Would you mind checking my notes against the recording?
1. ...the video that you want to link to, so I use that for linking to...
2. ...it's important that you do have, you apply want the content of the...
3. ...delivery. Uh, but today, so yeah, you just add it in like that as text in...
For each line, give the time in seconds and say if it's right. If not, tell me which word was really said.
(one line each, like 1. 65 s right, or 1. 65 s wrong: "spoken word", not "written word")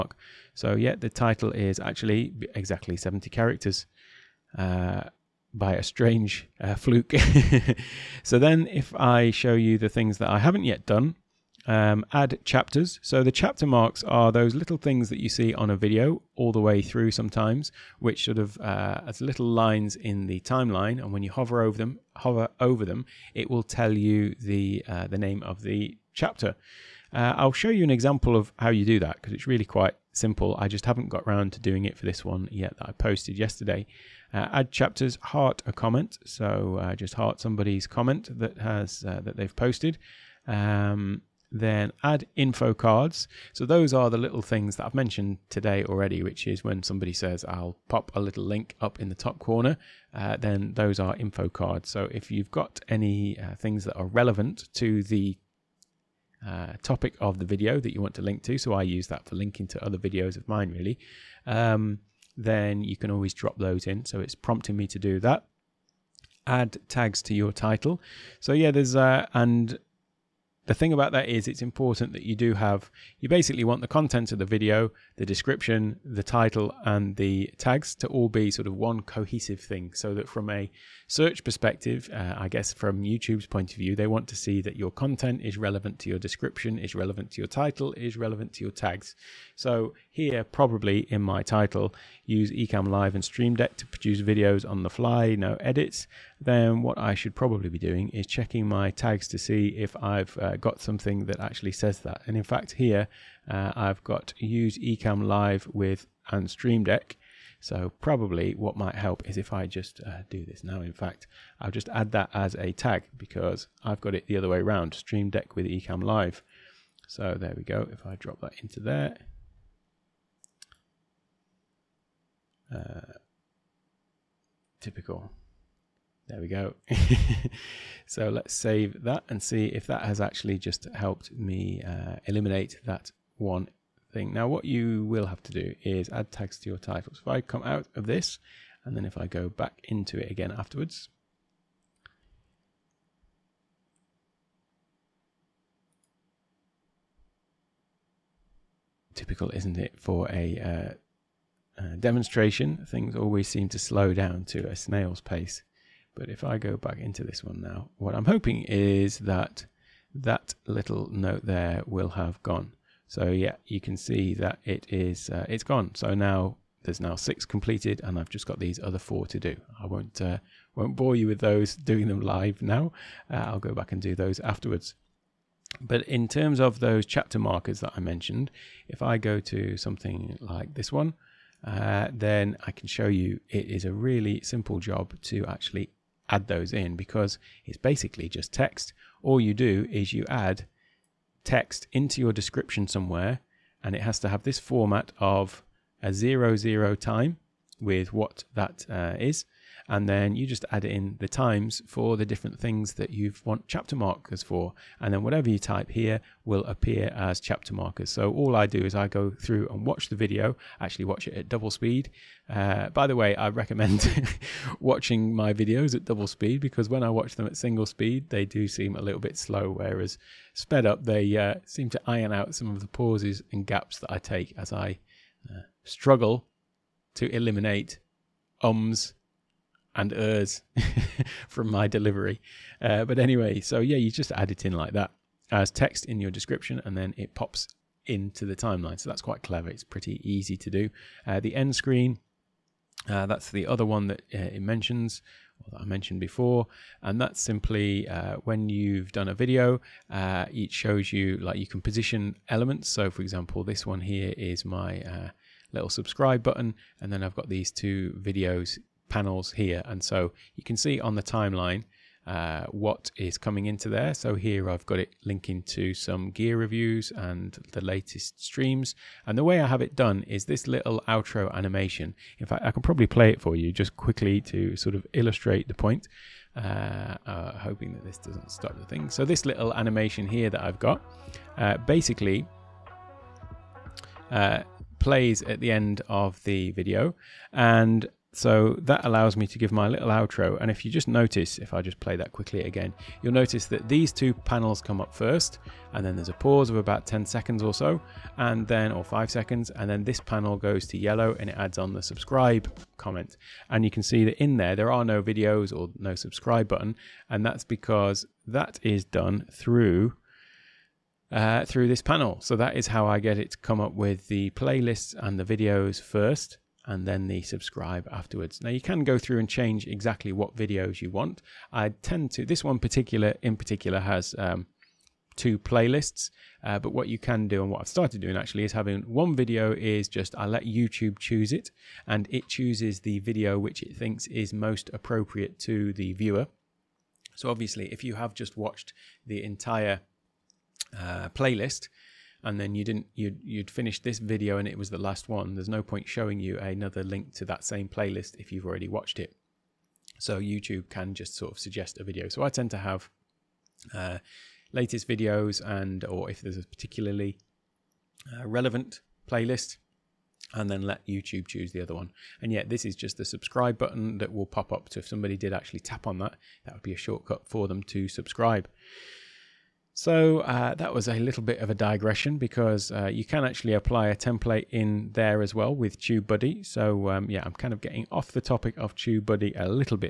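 1. 57 s right
2. 71 s wrong: "basically", not "apply"
3. 231 s wrong: "anyway", not "today".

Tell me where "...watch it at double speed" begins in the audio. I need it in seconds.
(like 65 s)
211 s.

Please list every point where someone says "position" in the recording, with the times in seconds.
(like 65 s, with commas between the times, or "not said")
251 s.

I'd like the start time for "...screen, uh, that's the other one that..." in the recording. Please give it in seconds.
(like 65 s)
241 s.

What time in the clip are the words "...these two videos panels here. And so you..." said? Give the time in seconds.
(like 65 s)
257 s.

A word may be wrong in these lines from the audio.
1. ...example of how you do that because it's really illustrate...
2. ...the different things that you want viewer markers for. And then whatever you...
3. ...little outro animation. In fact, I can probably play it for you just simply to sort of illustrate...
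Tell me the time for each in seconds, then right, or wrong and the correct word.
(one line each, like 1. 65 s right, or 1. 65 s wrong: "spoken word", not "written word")
1. 27 s wrong: "quite", not "illustrate"
2. 202 s wrong: "chapter", not "viewer"
3. 270 s wrong: "quickly", not "simply".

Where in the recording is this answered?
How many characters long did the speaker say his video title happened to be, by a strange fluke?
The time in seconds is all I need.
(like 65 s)
2 s.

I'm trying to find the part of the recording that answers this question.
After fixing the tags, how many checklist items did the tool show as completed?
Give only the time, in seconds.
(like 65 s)
167 s.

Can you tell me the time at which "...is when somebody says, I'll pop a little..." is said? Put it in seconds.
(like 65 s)
46 s.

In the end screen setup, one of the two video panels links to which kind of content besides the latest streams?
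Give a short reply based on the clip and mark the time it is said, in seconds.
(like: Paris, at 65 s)
gear reviews, at 266 s.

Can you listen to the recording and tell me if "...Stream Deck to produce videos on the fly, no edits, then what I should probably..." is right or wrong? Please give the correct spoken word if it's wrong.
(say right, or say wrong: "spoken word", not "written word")
right.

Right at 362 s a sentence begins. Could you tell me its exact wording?
And yet this is just the subscribe button that will pop up.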